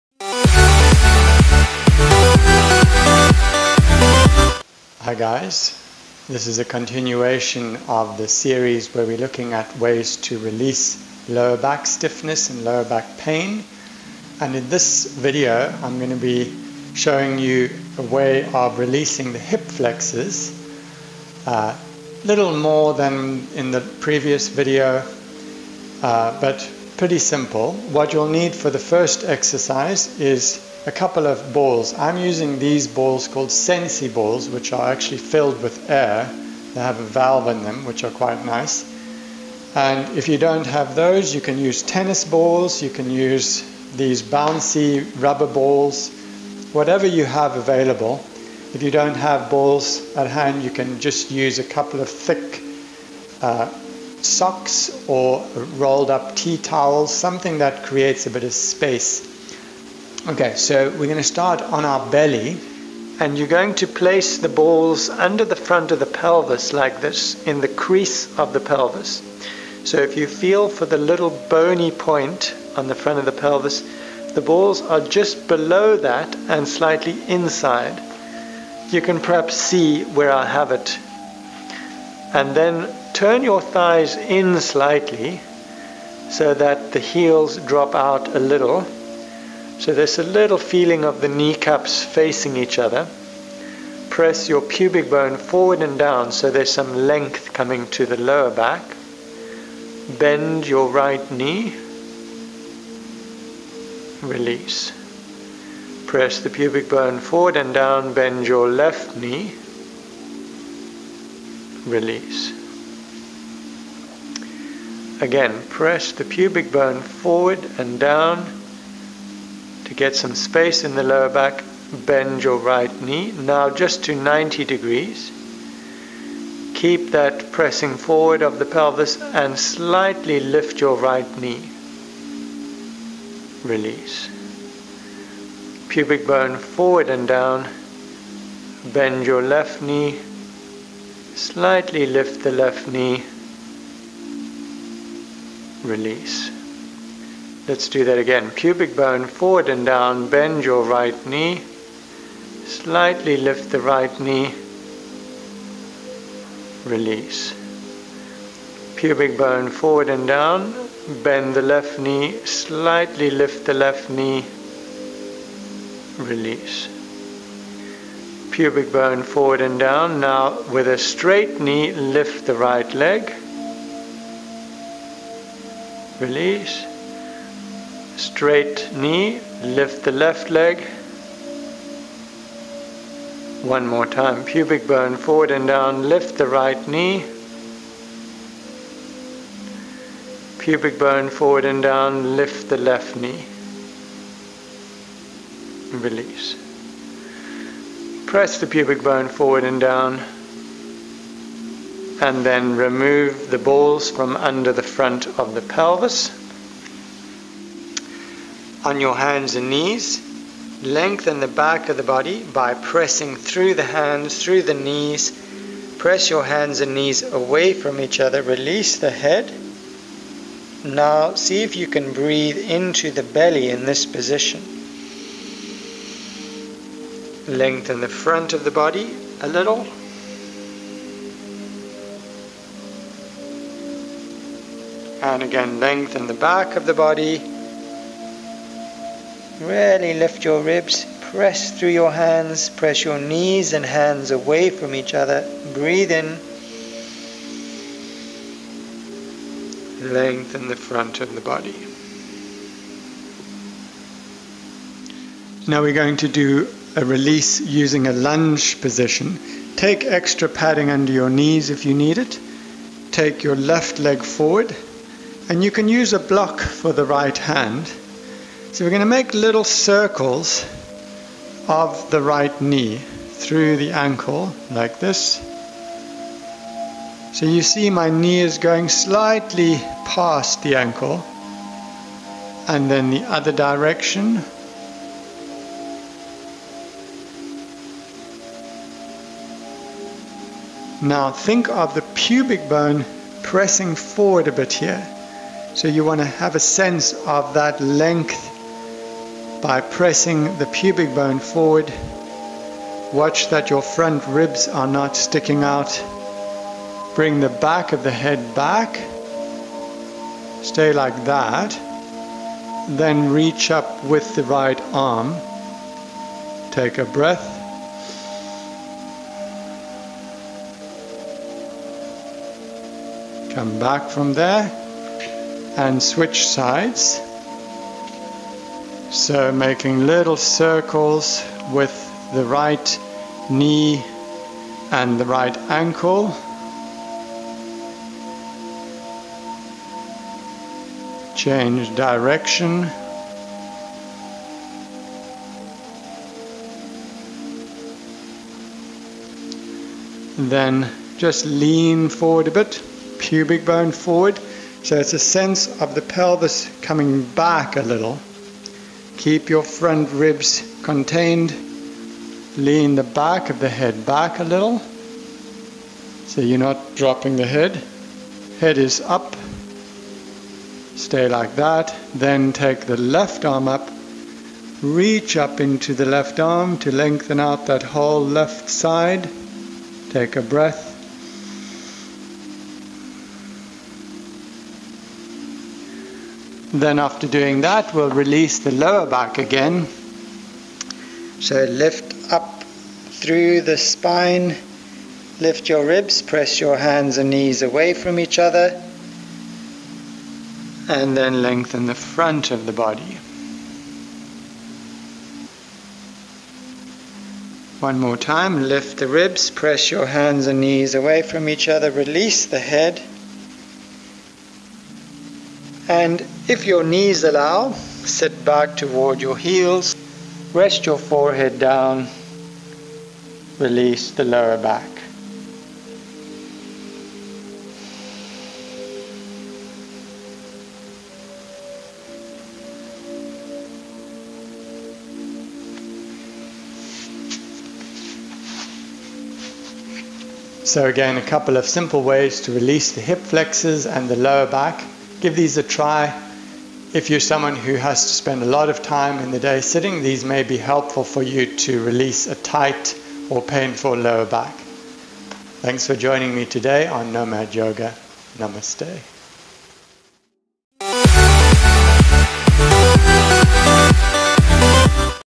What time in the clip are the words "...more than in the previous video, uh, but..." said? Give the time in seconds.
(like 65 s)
22 s.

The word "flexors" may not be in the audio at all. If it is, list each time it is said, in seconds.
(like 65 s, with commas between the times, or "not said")
19 s, 443 s.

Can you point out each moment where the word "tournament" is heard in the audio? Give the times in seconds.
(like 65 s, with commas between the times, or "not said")
not said.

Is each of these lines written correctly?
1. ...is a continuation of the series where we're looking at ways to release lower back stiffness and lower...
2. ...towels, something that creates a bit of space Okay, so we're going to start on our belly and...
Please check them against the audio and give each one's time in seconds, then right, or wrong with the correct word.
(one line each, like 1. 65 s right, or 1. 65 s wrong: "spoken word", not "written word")
1. 6 s right
2. 56 s right.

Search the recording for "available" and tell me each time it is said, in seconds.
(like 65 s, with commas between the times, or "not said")
47 s.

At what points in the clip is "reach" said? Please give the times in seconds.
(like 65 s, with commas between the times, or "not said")
313 s, 374 s.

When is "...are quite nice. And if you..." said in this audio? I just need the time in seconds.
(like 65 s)
38 s.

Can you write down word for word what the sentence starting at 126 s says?
Keep that pressing forward of the pelvis and slightly lift your right knee.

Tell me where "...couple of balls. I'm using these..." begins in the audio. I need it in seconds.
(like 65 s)
30 s.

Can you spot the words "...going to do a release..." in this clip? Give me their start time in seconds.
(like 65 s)
255 s.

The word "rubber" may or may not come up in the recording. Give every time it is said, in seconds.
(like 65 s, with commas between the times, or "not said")
45 s.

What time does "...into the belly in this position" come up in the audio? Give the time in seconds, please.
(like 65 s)
222 s.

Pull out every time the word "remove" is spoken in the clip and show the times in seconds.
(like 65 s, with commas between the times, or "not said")
202 s.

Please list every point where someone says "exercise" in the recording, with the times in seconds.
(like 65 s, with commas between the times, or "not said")
29 s.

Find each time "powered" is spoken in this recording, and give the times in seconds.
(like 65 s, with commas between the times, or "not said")
not said.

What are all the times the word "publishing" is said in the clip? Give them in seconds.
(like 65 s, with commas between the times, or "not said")
not said.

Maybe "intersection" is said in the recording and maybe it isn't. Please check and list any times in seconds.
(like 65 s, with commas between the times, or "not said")
not said.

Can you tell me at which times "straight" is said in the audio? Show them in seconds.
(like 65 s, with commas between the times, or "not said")
170 s, 178 s.